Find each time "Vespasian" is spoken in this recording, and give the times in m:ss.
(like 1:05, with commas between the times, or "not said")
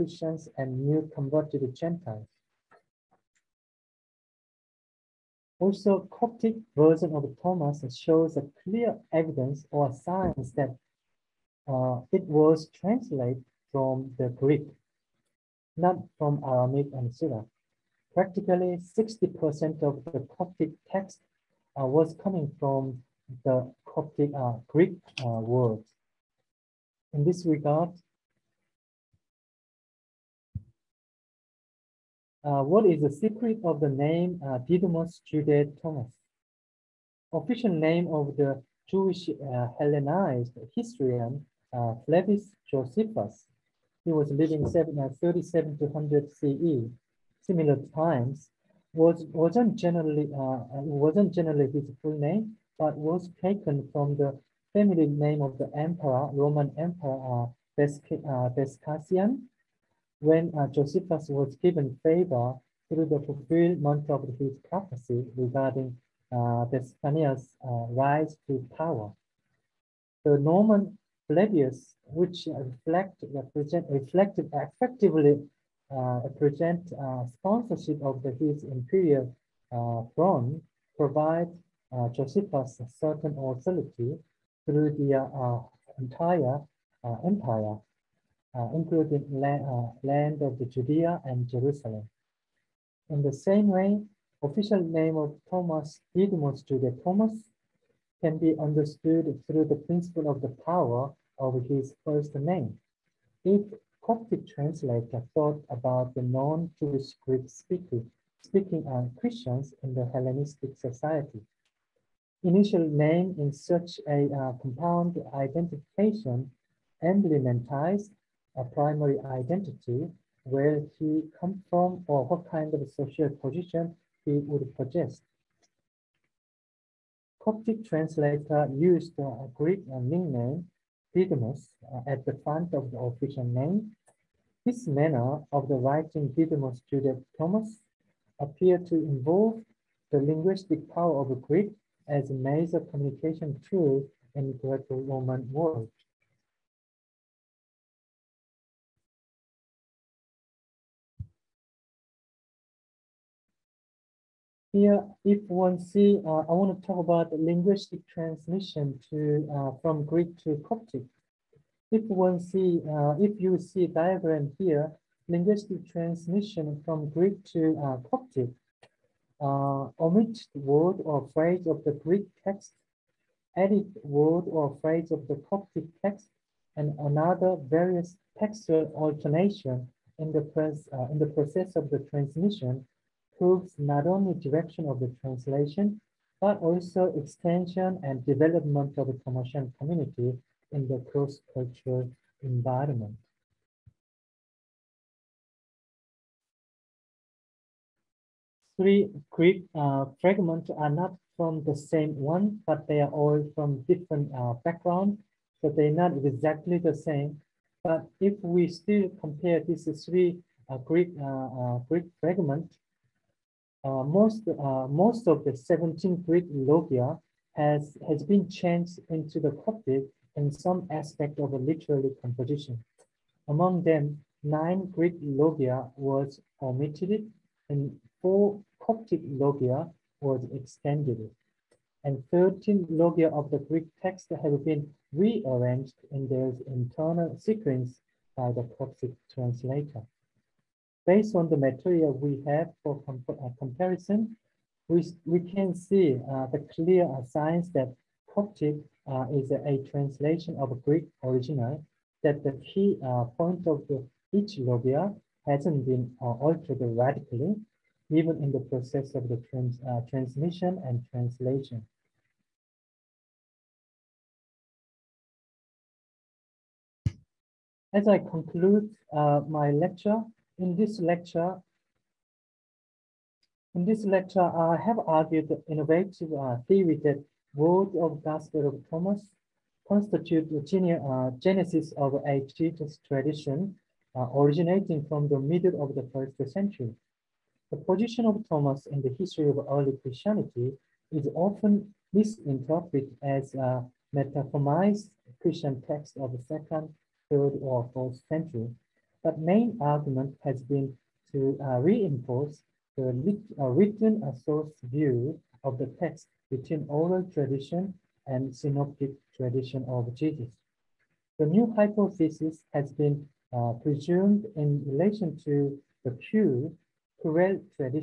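0:58, 1:06.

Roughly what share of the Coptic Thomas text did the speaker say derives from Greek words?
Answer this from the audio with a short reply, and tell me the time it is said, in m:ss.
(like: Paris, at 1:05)
60%, at 0:18.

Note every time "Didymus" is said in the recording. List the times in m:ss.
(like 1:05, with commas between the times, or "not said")
0:34, 1:36, 2:11, 2:16.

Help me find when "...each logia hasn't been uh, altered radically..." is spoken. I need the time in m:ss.
4:14.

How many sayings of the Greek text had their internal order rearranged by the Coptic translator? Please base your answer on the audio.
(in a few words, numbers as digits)
13.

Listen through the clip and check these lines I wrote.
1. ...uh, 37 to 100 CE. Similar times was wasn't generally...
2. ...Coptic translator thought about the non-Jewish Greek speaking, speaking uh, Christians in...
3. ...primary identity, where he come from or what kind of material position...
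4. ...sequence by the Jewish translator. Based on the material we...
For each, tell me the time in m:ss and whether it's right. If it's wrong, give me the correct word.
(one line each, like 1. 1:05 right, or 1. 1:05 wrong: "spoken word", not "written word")
1. 0:44 right
2. 1:44 right
3. 1:58 wrong: "social", not "material"
4. 3:57 wrong: "Coptic", not "Jewish".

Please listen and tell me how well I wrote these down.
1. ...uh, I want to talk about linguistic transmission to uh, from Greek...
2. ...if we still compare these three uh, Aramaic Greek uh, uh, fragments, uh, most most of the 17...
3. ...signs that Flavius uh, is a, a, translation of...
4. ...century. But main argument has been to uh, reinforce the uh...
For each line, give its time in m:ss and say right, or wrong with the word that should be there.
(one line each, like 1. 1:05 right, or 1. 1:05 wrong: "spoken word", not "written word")
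1. 2:36 right
2. 3:28 wrong: "Greek", not "Aramaic"
3. 4:07 wrong: "Coptic", not "Flavius"
4. 4:58 right.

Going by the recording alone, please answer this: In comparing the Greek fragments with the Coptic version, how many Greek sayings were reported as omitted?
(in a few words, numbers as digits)
9.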